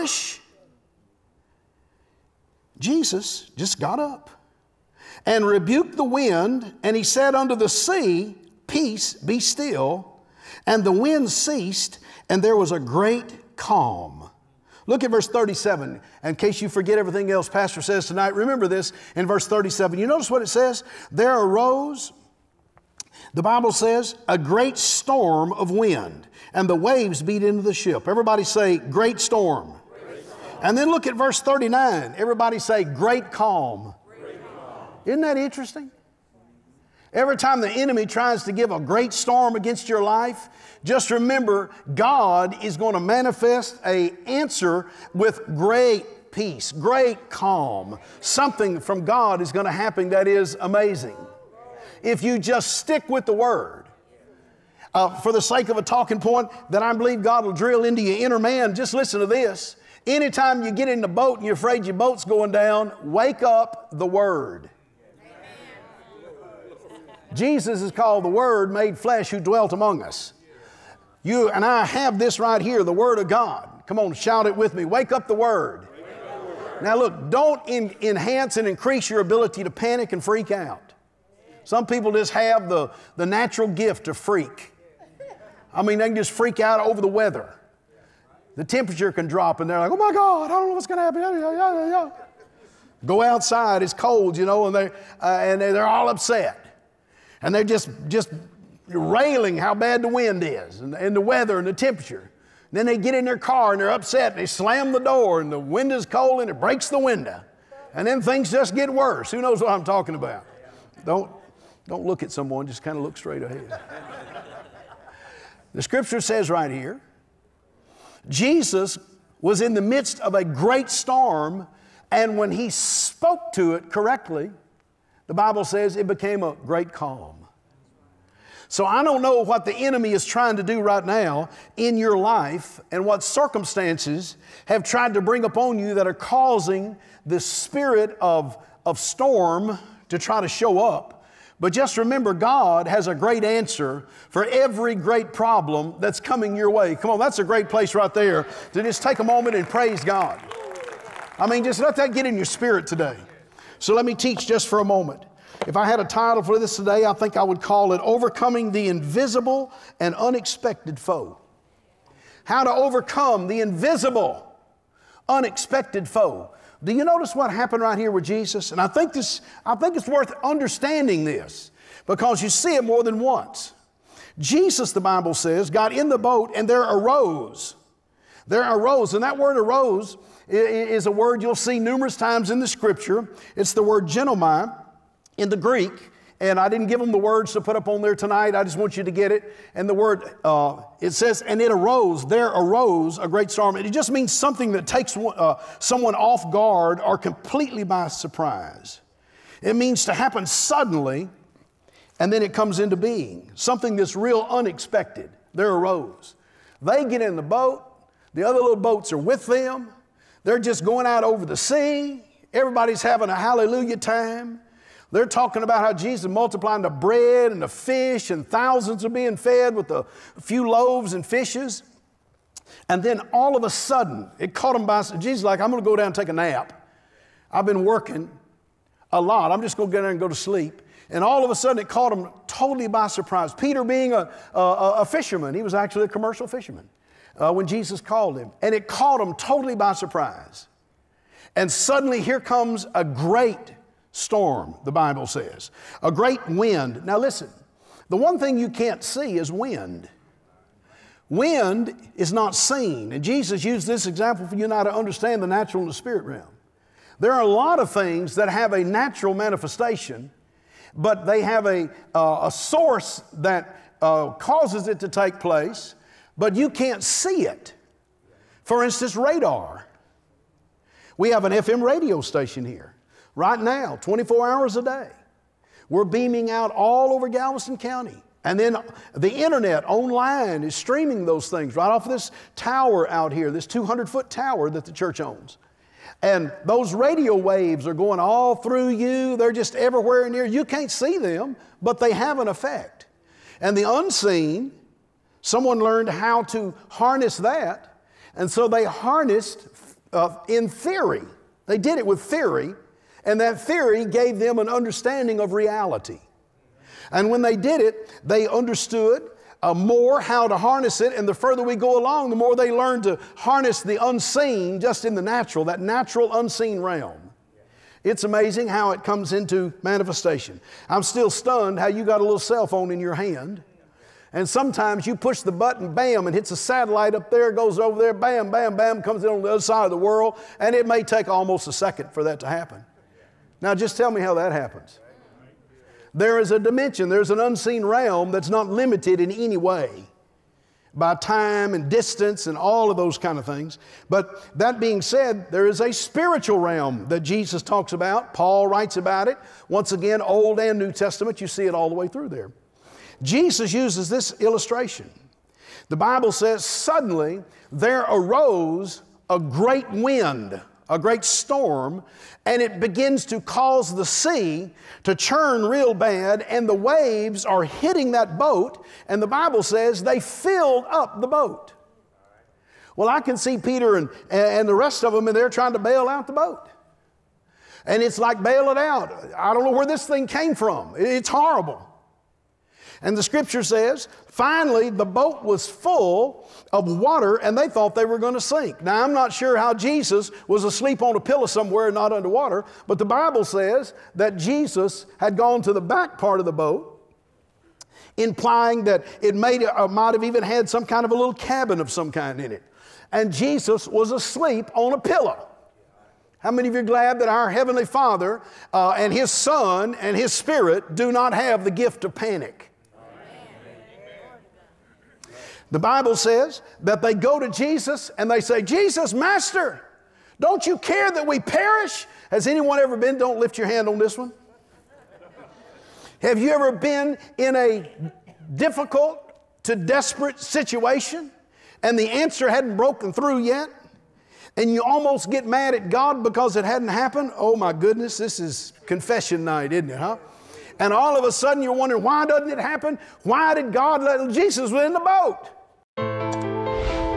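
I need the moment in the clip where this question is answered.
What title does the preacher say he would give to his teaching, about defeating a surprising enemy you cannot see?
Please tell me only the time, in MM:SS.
02:38.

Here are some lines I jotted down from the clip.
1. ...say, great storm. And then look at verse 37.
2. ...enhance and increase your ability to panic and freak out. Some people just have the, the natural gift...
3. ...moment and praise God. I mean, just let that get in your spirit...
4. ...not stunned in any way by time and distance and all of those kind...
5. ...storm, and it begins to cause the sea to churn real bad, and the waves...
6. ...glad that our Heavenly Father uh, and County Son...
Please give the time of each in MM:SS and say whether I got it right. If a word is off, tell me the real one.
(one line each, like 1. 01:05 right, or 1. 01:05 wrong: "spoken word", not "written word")
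1. 00:28 wrong: "39", not "37"
2. 01:17 right
3. 02:29 right
4. 05:38 wrong: "limited", not "stunned"
5. 06:01 right
6. 06:46 wrong: "His", not "County".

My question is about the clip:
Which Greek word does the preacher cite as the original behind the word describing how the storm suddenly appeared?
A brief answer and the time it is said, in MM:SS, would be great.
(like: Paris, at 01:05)
ginomai, at 03:04.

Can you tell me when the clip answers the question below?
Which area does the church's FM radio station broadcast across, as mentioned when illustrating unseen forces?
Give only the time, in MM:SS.
04:37.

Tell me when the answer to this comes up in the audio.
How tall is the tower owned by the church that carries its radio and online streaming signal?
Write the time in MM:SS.
04:43.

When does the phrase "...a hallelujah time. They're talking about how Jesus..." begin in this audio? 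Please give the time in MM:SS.
03:33.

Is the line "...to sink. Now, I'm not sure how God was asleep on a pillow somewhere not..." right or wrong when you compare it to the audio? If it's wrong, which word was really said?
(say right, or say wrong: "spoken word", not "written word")
wrong: "Jesus", not "God".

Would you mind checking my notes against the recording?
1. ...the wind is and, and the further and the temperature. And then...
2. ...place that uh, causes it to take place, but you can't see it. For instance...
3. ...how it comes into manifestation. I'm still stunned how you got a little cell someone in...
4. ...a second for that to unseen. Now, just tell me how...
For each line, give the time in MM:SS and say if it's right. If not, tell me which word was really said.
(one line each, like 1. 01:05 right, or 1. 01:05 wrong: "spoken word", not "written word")
1. 01:40 wrong: "weather", not "further"
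2. 04:22 wrong: "source", not "place"
3. 05:18 wrong: "phone", not "someone"
4. 05:31 wrong: "happen", not "unseen".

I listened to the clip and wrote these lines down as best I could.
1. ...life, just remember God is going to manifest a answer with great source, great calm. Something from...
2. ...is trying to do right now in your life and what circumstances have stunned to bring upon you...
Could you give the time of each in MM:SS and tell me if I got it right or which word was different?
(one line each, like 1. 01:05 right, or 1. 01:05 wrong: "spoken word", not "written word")
1. 00:40 wrong: "peace", not "source"
2. 02:10 wrong: "tried", not "stunned".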